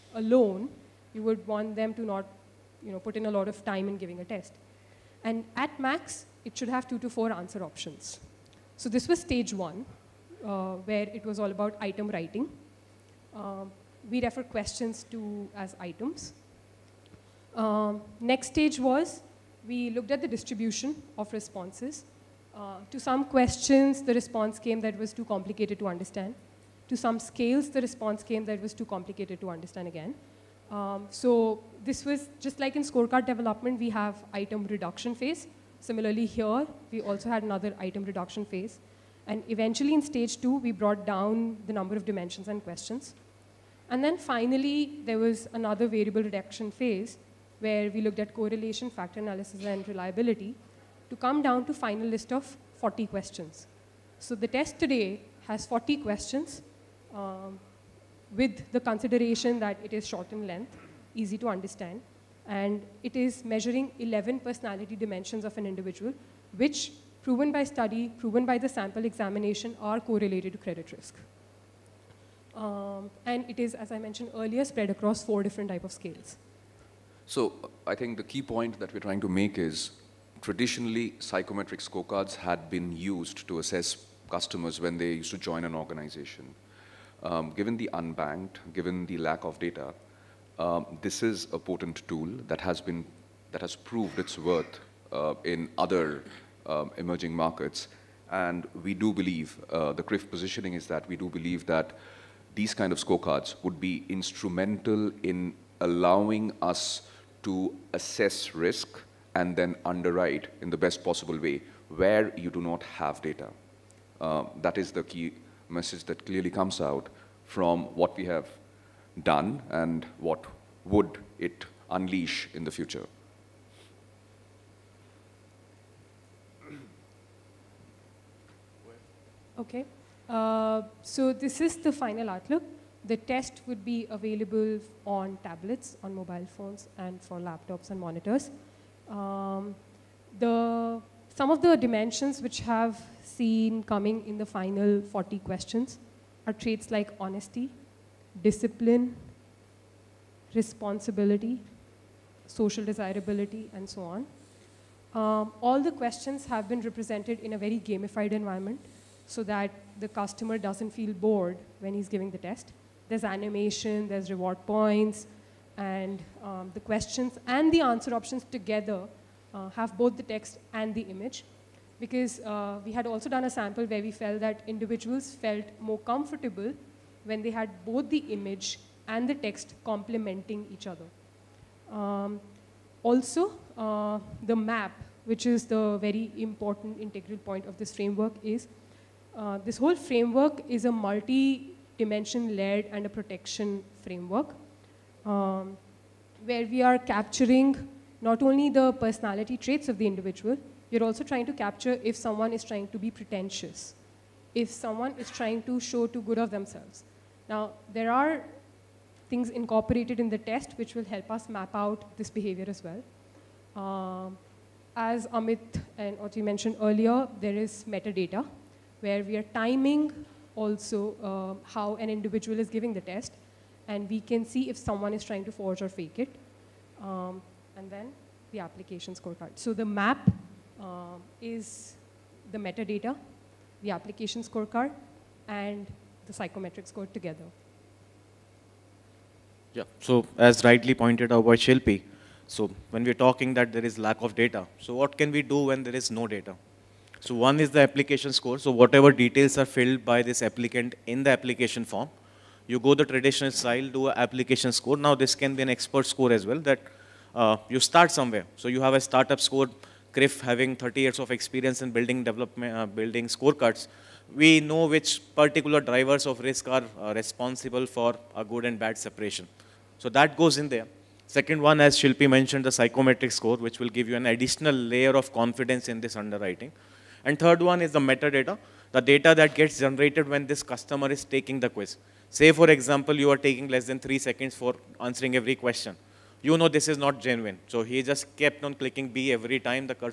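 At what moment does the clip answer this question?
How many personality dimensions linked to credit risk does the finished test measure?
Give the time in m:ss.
1:03.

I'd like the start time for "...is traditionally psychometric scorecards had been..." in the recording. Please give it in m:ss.
1:19.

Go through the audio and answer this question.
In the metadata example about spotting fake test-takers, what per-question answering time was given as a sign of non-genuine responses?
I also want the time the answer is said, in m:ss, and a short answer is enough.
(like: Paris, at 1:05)
less than 3 seconds, at 4:43.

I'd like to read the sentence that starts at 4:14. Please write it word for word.
Now this can be an expert score as well that uh, you start somewhere.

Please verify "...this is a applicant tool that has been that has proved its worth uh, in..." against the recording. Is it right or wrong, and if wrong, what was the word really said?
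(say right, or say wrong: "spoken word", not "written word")
wrong: "potent", not "applicant".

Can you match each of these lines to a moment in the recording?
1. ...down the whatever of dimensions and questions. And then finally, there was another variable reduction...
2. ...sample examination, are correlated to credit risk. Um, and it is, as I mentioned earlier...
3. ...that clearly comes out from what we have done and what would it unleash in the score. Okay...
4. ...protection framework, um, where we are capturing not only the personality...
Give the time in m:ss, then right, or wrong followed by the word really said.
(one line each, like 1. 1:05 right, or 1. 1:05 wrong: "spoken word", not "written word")
1. 0:41 wrong: "number", not "whatever"
2. 1:08 right
3. 1:56 wrong: "future", not "score"
4. 3:13 right.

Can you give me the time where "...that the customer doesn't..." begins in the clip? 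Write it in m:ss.
2:39.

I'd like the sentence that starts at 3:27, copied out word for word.
Now, there are things incorporated in the test which will help us map out this behavior as well.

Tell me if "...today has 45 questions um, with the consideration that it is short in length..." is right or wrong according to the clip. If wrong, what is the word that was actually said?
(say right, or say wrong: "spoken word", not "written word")
wrong: "40", not "45".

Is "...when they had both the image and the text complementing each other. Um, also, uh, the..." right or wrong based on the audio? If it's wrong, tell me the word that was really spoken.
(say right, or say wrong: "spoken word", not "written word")
right.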